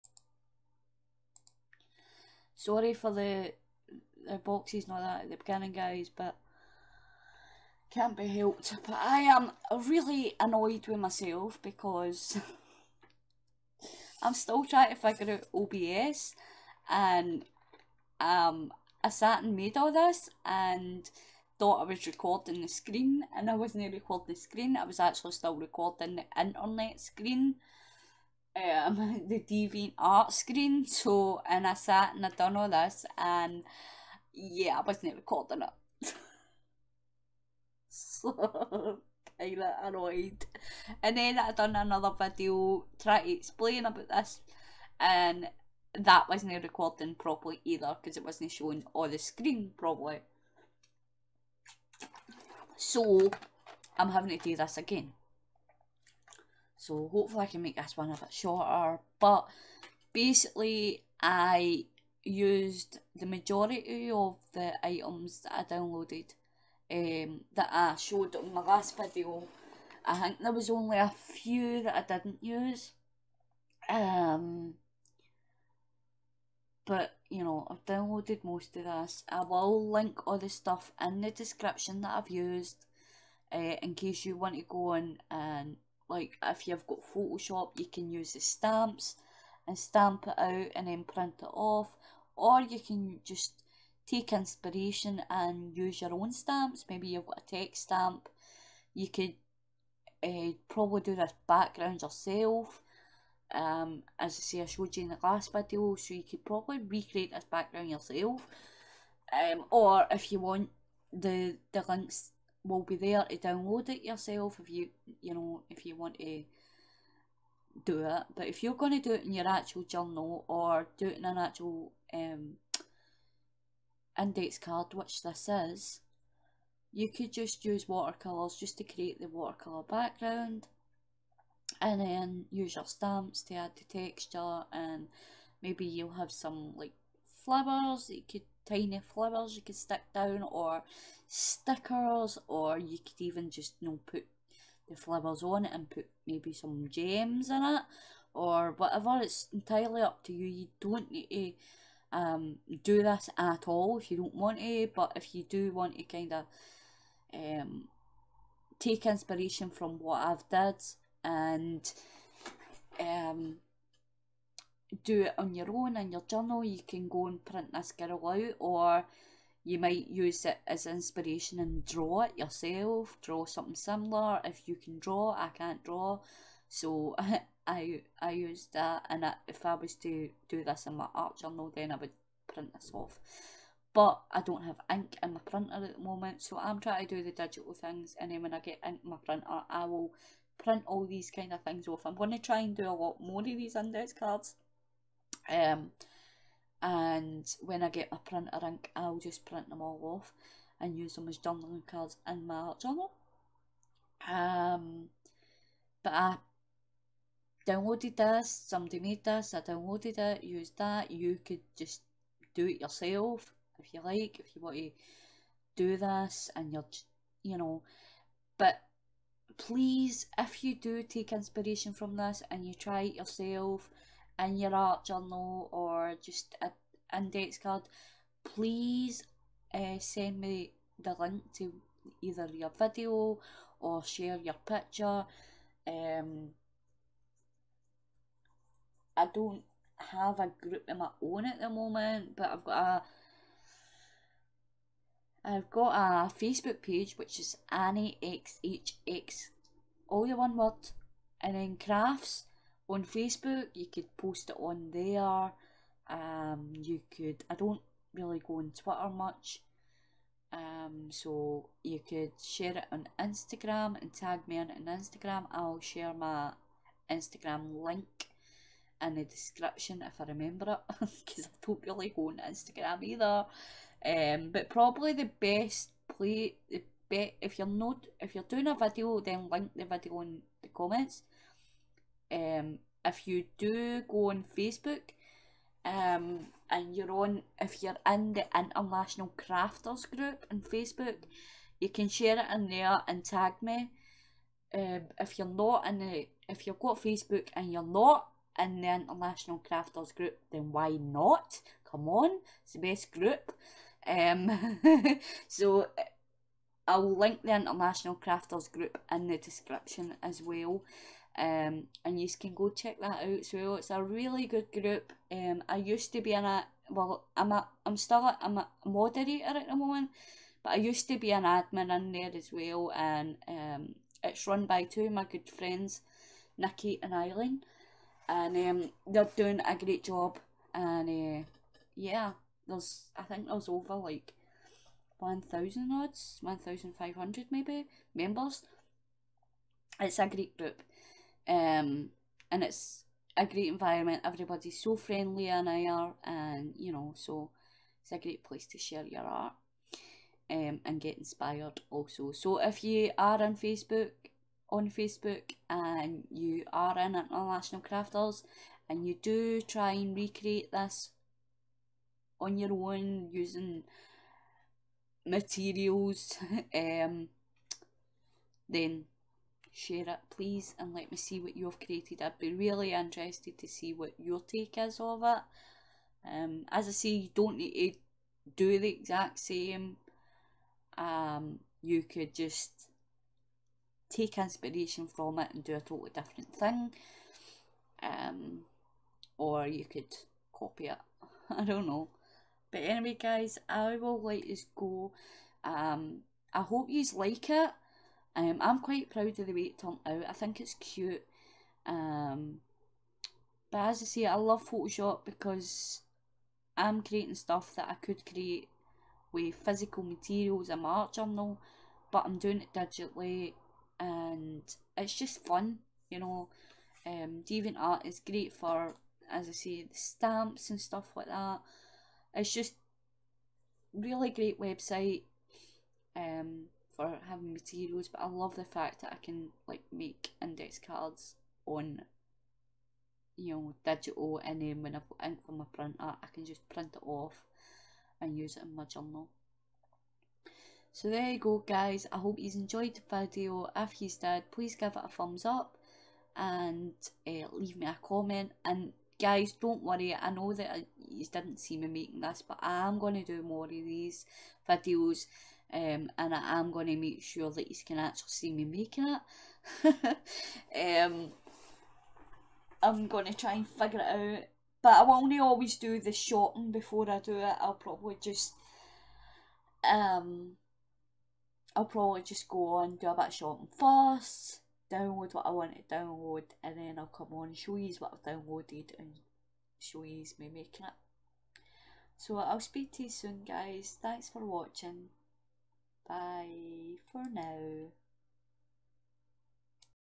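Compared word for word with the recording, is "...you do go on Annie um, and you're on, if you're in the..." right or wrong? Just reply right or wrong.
wrong.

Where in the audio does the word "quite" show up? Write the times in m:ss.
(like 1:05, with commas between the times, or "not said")
6:38.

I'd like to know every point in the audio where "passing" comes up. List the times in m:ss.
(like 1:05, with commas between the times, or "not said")
not said.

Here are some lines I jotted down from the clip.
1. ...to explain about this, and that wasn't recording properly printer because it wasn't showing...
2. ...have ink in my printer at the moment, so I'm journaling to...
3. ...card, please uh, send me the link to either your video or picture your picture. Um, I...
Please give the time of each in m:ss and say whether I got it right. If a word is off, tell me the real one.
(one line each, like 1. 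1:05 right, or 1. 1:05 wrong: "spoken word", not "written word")
1. 0:43 wrong: "either", not "printer"
2. 3:04 wrong: "trying", not "journaling"
3. 3:47 wrong: "share", not "picture".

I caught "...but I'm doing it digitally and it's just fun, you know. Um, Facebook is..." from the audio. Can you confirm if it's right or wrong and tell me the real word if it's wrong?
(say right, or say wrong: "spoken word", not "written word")
wrong: "DeviantArt", not "Facebook".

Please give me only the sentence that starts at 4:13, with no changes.
You could post it on there.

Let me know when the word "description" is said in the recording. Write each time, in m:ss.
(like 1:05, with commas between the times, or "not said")
1:21, 4:29, 5:09.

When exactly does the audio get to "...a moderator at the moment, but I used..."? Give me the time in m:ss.
5:18.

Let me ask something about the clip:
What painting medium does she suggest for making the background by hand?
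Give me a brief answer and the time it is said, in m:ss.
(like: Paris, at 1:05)
Watercolours, at 2:07.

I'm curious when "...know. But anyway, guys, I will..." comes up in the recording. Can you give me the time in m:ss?
6:31.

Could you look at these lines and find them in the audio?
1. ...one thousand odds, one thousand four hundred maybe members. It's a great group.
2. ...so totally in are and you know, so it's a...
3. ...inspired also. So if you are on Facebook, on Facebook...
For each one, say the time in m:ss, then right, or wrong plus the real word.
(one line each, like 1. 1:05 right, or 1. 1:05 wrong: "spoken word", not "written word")
1. 5:35 wrong: "five", not "four"
2. 5:44 wrong: "friendly", not "totally"
3. 5:51 right.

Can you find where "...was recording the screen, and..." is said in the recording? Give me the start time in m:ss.
0:21.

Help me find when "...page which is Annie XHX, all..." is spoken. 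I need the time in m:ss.
4:06.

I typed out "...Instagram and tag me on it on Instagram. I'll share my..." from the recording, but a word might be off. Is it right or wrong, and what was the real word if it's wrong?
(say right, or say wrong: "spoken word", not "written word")
right.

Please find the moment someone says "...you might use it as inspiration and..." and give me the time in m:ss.
2:49.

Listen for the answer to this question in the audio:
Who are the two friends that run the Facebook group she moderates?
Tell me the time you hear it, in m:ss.
5:26.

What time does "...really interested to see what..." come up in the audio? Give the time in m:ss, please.
6:12.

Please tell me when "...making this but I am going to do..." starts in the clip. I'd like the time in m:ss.
7:31.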